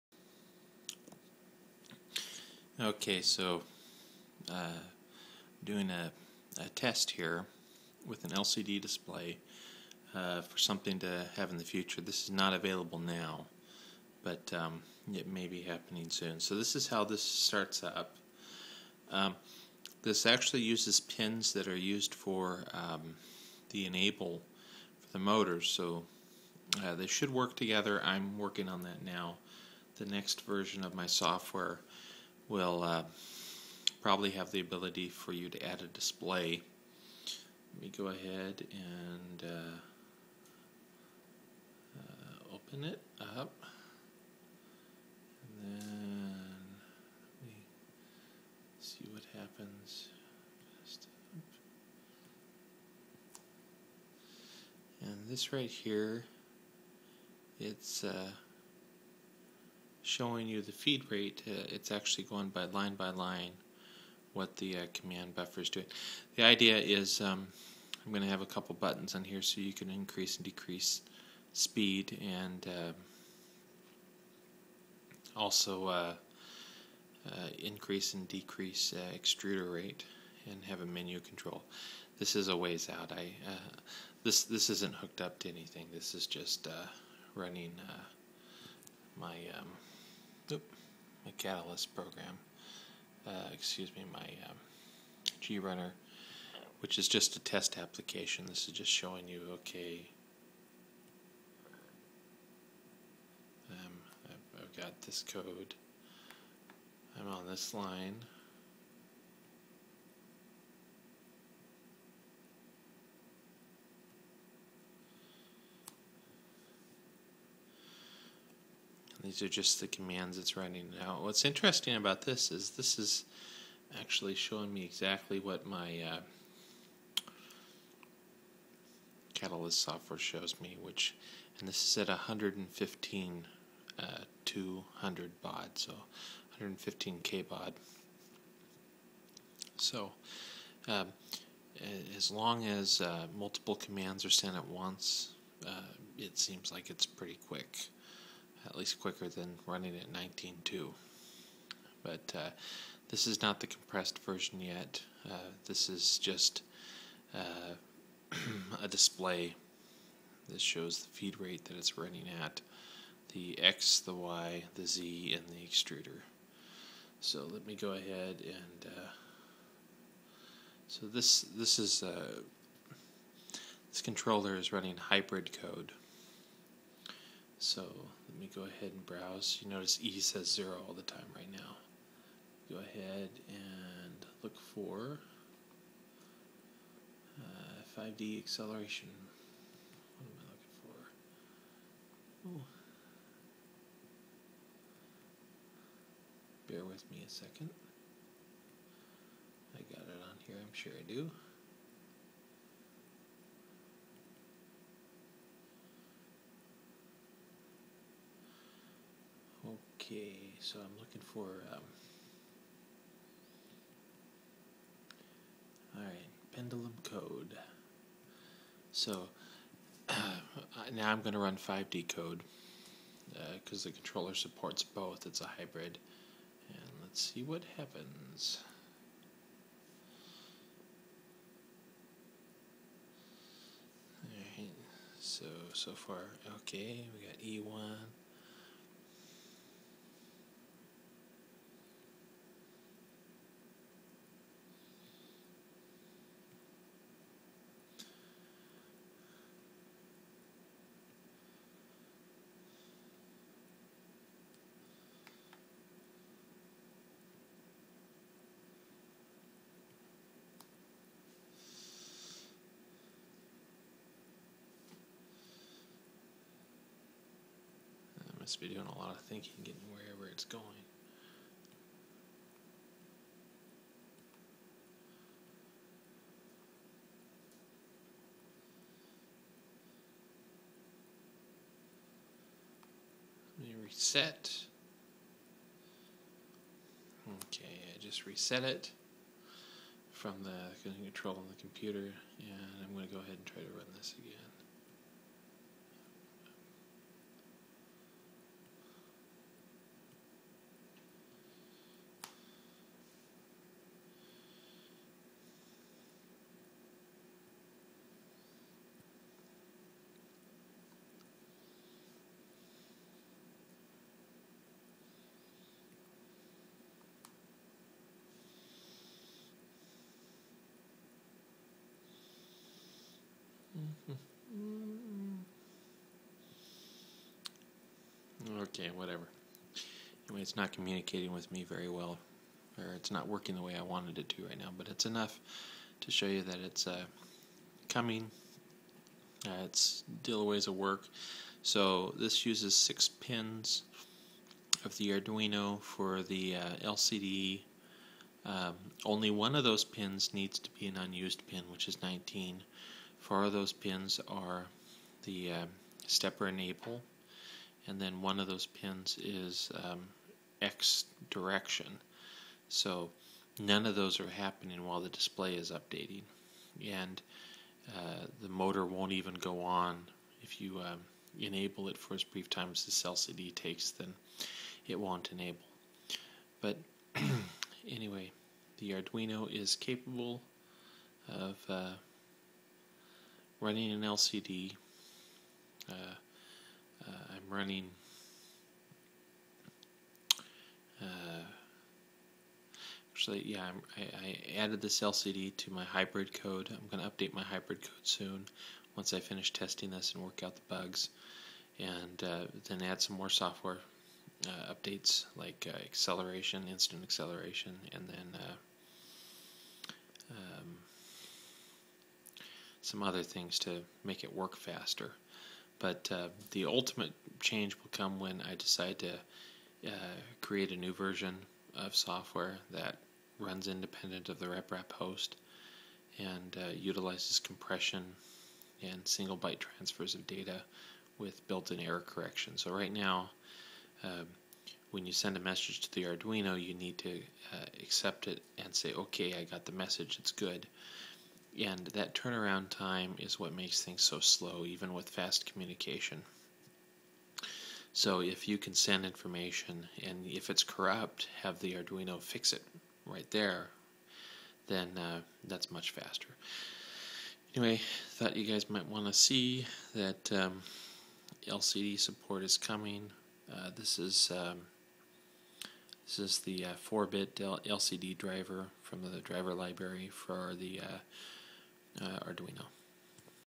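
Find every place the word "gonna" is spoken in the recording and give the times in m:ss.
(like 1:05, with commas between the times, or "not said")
6:36.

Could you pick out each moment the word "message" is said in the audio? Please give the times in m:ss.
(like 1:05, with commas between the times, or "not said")
7:15, 7:19.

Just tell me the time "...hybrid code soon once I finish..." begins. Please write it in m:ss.
6:37.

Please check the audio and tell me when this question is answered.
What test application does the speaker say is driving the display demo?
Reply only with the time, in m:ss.
1:35.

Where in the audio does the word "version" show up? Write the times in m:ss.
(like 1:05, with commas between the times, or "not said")
0:30, 2:34, 7:00.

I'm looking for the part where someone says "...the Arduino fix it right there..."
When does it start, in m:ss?
7:31.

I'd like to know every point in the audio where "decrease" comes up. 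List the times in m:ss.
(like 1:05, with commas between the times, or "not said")
1:10, 1:18.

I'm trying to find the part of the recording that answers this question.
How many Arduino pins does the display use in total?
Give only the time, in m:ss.
5:42.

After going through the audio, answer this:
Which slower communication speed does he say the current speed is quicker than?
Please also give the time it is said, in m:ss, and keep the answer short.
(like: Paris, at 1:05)
19.2, at 2:30.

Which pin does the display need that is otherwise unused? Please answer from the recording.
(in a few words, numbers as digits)
19.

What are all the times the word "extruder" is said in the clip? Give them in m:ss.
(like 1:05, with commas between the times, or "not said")
1:19, 2:45.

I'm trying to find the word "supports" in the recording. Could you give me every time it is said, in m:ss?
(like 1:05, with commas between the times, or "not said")
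3:44, 7:41.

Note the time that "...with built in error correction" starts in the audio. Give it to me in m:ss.
7:11.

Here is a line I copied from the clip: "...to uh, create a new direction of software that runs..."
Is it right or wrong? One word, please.
wrong.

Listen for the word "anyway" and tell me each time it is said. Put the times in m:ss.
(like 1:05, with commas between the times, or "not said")
5:30, 6:17, 7:37.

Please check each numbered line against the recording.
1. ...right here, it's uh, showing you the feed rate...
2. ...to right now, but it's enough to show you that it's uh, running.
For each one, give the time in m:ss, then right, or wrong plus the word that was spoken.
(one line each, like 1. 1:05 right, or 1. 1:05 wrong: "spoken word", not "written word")
1. 0:55 right
2. 5:34 wrong: "coming", not "running".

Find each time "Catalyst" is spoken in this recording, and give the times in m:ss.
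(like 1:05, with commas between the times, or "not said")
1:31, 2:09.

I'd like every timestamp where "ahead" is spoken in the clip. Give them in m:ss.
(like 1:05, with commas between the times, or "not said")
0:38, 2:47, 2:58, 3:02, 4:53.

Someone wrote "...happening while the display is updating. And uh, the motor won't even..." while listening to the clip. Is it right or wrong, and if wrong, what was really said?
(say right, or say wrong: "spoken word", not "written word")
right.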